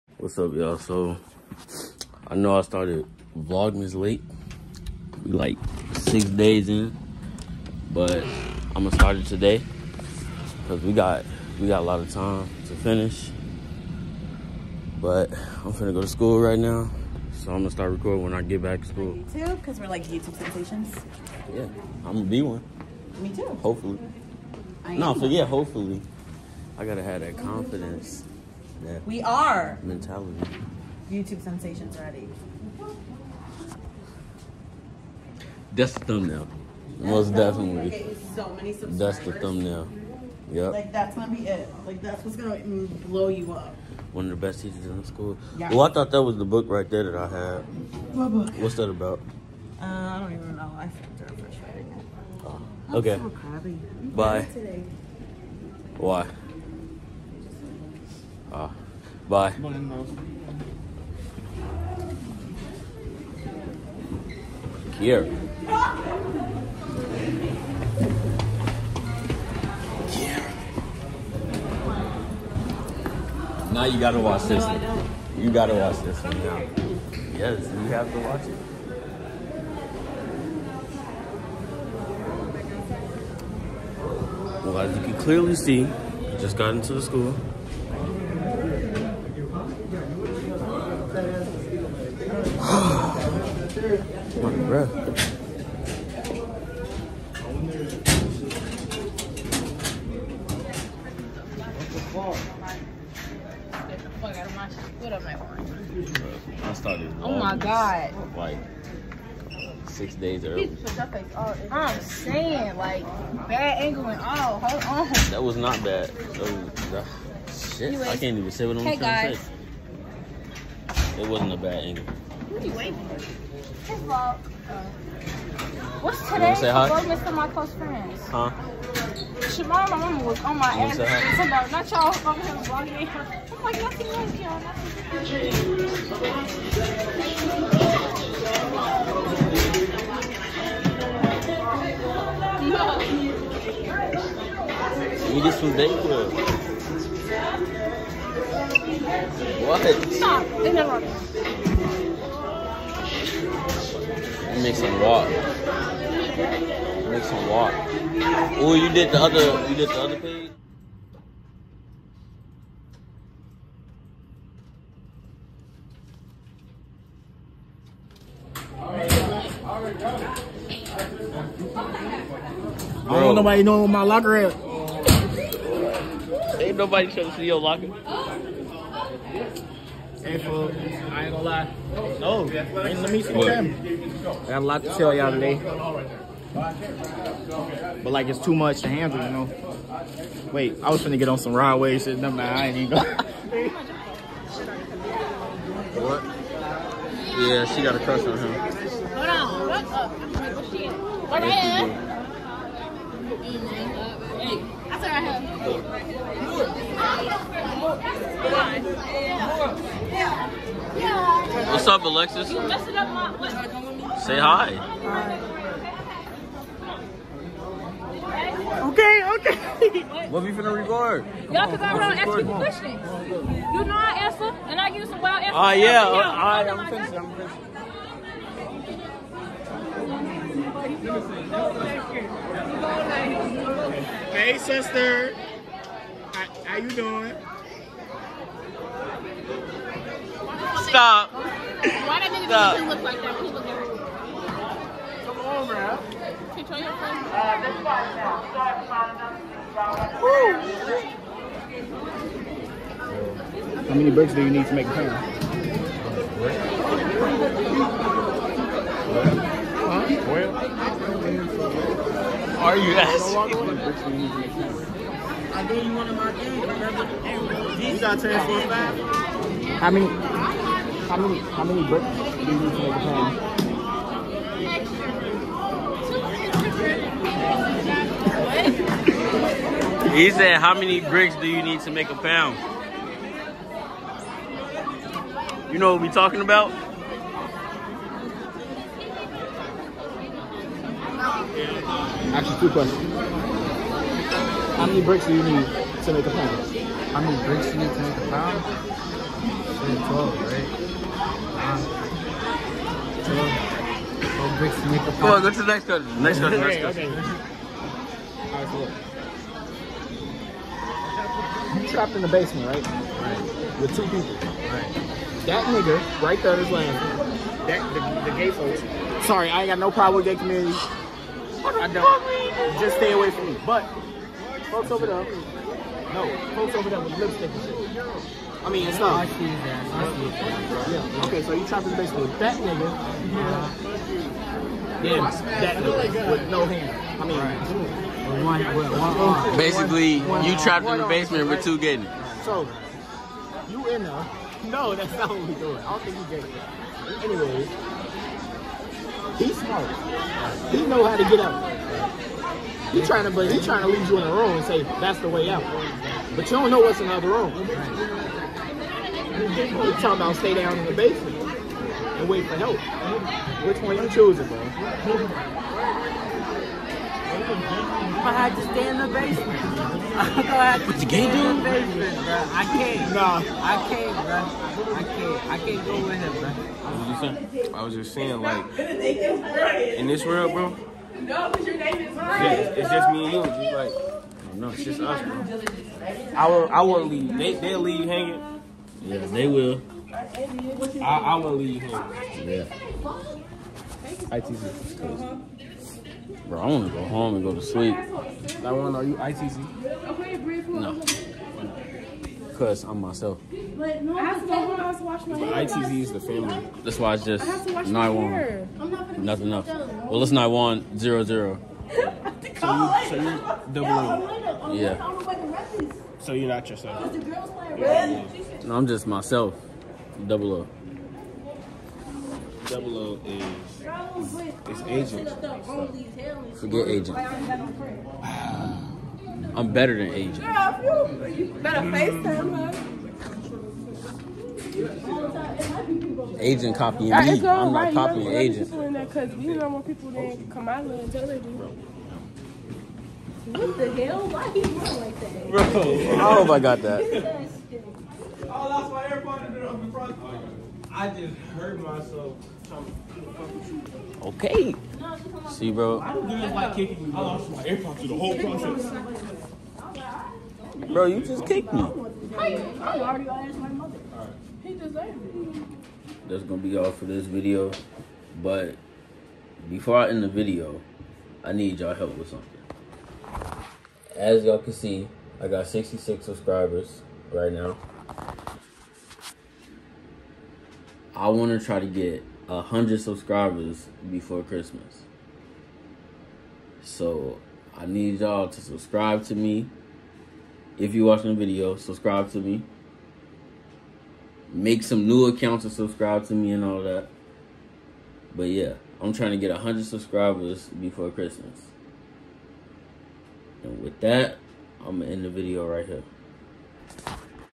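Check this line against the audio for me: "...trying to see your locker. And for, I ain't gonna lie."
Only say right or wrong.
right.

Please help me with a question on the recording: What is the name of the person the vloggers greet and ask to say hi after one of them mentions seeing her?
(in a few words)
Alexis.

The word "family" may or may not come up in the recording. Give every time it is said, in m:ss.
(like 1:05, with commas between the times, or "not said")
6:46.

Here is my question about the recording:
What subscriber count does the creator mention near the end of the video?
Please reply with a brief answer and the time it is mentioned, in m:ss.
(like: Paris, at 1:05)
66, at 7:55.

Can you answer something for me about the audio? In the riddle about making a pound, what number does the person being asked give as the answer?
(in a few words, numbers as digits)
12.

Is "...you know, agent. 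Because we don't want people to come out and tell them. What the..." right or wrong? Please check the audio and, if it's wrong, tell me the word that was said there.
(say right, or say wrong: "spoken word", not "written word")
right.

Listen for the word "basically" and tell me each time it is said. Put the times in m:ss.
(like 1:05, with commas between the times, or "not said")
5:31, 5:39.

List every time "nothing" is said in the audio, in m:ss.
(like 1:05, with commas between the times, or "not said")
2:13, 6:49.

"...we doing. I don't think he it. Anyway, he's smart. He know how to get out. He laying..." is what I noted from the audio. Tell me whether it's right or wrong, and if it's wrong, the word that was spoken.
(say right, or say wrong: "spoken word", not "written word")
wrong: "trying", not "laying".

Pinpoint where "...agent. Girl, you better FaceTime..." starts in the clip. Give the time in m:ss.
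7:10.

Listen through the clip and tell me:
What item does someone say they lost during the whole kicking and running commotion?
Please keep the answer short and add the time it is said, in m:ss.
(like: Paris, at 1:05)
AirPods, at 7:37.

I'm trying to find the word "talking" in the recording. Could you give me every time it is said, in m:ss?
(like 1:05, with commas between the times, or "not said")
4:46, 5:59.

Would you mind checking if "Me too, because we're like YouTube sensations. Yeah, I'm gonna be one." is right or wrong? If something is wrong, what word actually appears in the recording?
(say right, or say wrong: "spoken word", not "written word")
right.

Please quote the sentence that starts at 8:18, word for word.
But yeah, I'm trying to get 100 subscribers before Christmas.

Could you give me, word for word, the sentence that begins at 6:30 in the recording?
I, I will to leave you home.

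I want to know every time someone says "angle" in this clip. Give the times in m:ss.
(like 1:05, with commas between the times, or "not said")
1:53, 2:01.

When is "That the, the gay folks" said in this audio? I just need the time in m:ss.
5:17.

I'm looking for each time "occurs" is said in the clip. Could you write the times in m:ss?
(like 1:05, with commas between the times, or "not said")
not said.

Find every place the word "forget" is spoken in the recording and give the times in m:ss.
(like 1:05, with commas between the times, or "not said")
0:25, 7:06.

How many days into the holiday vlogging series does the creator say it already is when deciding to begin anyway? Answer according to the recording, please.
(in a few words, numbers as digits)
6.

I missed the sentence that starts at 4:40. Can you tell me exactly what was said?
He said, how many bricks do you need to make a pound?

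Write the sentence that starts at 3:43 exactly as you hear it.
You know I answer, and I use some wild answers.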